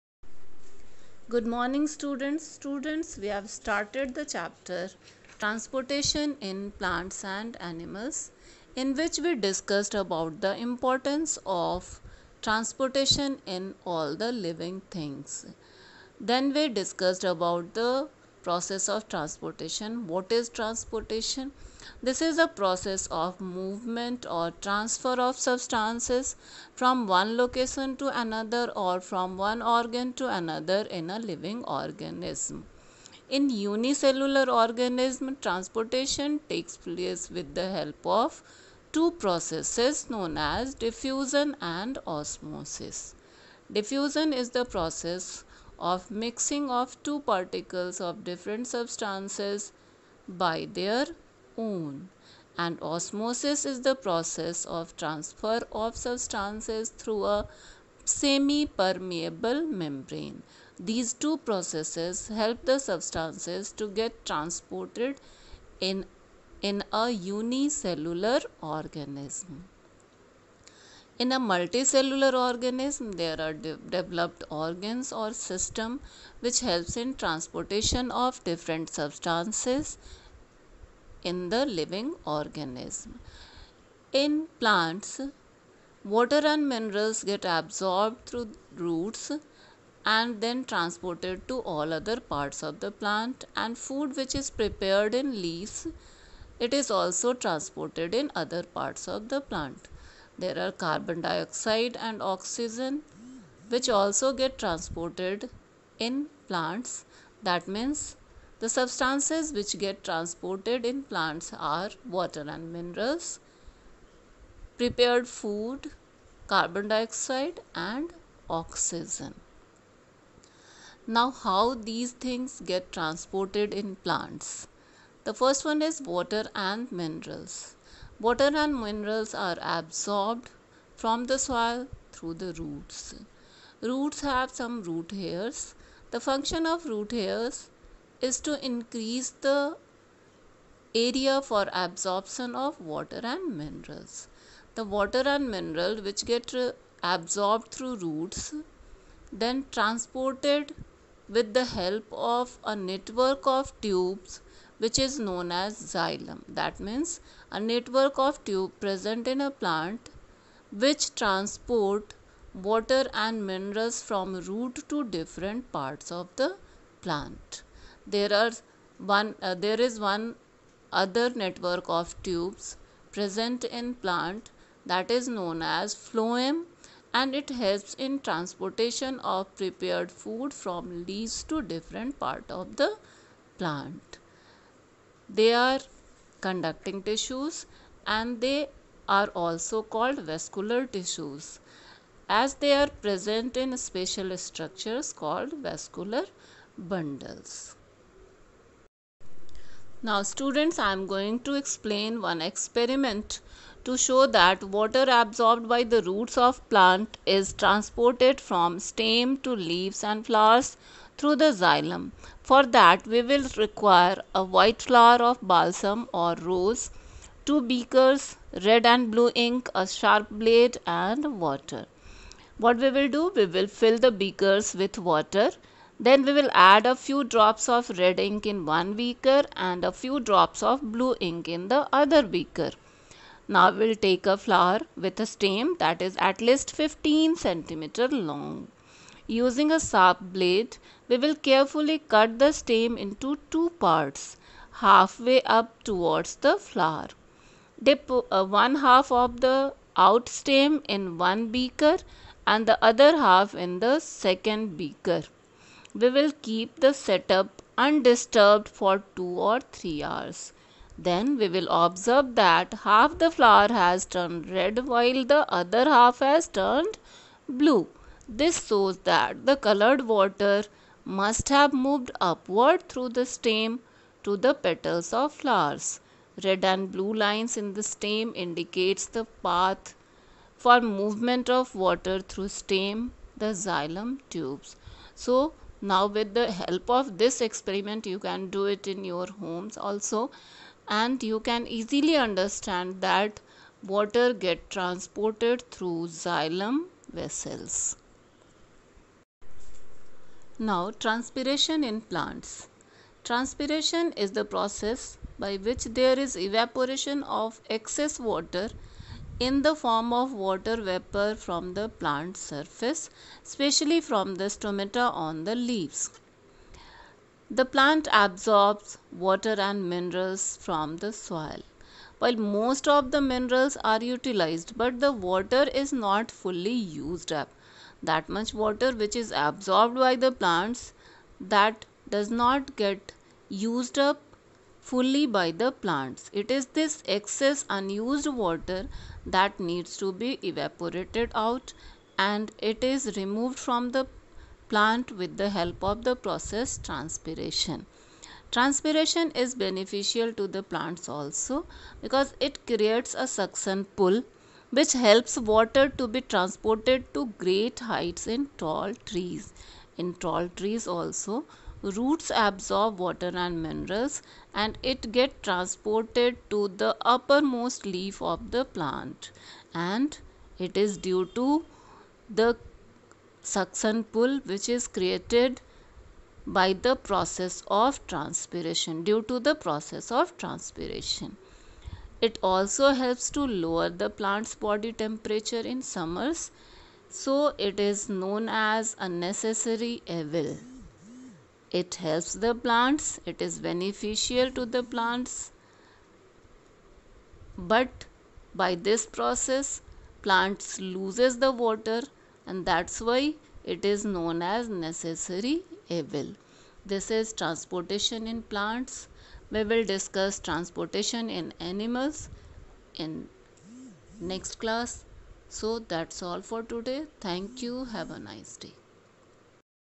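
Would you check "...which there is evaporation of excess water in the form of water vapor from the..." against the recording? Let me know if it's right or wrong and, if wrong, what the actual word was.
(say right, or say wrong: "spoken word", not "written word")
right.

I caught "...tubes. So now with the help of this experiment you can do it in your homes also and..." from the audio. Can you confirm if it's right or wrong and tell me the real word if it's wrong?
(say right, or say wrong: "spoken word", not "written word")
right.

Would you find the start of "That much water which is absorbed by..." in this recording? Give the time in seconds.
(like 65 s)
328 s.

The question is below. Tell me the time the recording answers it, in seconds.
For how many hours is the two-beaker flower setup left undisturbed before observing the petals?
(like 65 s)
259 s.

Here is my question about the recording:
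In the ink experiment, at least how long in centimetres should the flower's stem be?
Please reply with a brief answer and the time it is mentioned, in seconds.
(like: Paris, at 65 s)
15, at 236 s.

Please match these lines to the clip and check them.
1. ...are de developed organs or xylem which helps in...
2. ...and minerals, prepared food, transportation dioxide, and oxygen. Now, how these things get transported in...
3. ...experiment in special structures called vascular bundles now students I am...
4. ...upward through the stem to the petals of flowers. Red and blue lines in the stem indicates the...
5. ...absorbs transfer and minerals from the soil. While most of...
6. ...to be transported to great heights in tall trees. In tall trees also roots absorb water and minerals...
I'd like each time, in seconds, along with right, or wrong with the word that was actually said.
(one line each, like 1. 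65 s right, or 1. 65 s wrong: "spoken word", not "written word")
1. 73 s wrong: "system", not "xylem"
2. 112 s wrong: "carbon", not "transportation"
3. 193 s wrong: "present", not "experiment"
4. 272 s right
5. 318 s wrong: "water", not "transfer"
6. 355 s right.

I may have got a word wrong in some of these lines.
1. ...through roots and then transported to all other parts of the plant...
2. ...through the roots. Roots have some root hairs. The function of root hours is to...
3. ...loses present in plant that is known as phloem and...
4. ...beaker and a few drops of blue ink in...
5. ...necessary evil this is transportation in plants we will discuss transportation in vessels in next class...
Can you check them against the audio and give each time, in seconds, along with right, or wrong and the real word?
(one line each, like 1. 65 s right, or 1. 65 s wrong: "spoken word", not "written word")
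1. 88 s right
2. 132 s wrong: "hairs", not "hours"
3. 172 s wrong: "tubes", not "loses"
4. 228 s right
5. 404 s wrong: "animals", not "vessels".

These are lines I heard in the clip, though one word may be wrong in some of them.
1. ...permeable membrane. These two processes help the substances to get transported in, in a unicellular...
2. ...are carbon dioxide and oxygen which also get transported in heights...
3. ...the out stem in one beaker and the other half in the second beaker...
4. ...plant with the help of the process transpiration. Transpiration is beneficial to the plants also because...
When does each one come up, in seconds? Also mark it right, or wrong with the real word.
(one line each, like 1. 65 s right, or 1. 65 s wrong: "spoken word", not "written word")
1. 58 s right
2. 100 s wrong: "plants", not "heights"
3. 249 s right
4. 344 s right.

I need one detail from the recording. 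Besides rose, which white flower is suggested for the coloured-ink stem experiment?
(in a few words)
balsam.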